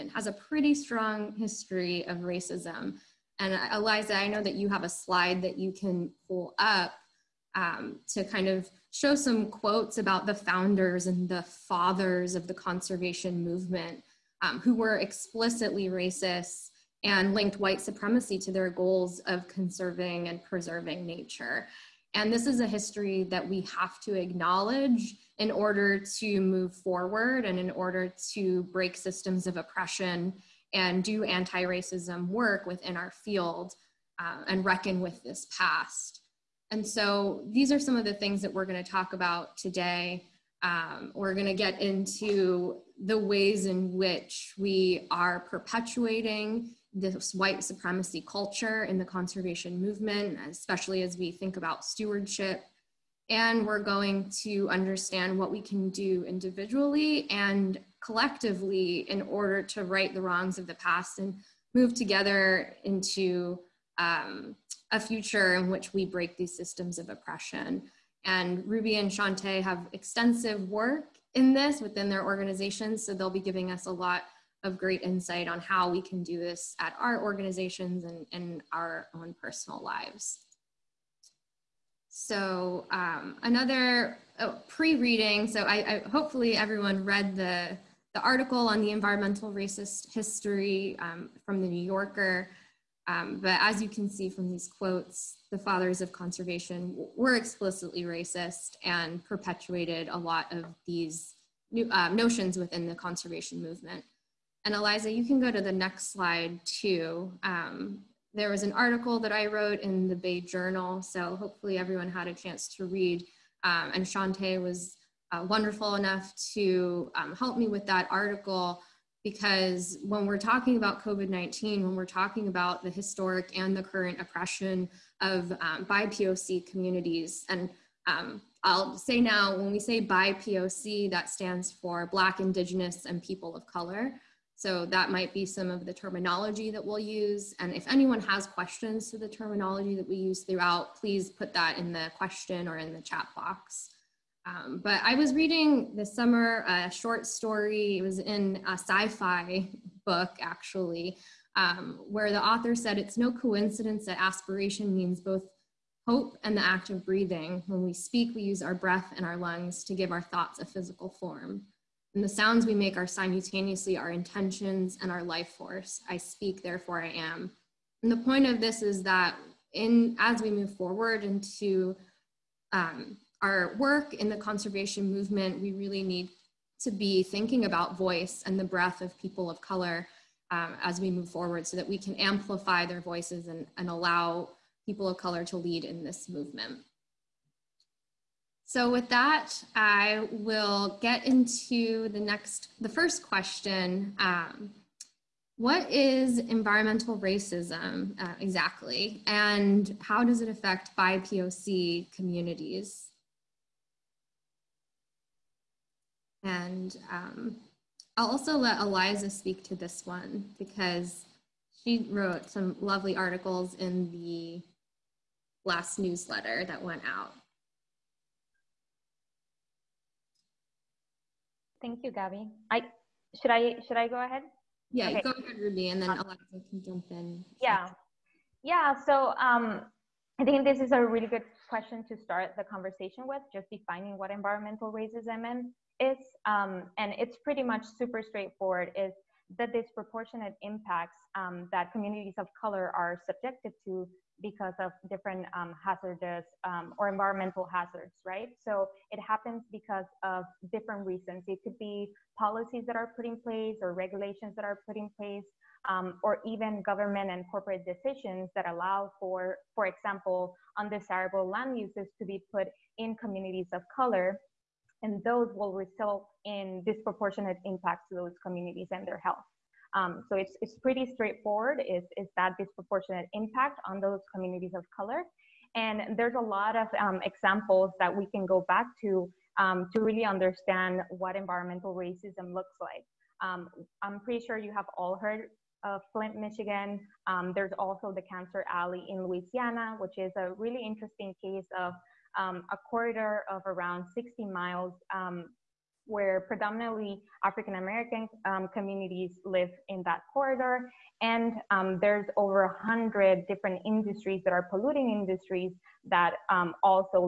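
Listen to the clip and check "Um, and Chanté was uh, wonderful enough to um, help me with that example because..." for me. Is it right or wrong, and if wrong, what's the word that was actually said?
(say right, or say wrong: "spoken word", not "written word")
wrong: "article", not "example".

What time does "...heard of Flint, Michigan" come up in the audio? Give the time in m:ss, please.
4:45.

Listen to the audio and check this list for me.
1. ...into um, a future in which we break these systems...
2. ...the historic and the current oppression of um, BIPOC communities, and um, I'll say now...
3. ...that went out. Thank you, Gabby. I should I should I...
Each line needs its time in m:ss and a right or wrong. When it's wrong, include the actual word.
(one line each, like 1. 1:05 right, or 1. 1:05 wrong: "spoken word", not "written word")
1. 1:02 right
2. 2:02 right
3. 3:36 right.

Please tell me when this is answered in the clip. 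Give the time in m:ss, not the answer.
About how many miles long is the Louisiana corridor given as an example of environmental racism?
4:54.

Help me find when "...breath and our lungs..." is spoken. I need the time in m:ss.
2:38.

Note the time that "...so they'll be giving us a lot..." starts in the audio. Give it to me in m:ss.
1:13.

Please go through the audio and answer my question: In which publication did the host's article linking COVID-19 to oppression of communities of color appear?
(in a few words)
Bay Journal.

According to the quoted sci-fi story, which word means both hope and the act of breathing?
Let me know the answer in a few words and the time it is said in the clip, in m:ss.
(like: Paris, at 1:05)
Aspiration, at 2:34.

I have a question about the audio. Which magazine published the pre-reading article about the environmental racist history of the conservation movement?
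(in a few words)
The New Yorker.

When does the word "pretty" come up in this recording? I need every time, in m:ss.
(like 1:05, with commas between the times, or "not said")
0:00, 3:57, 4:30, 4:44.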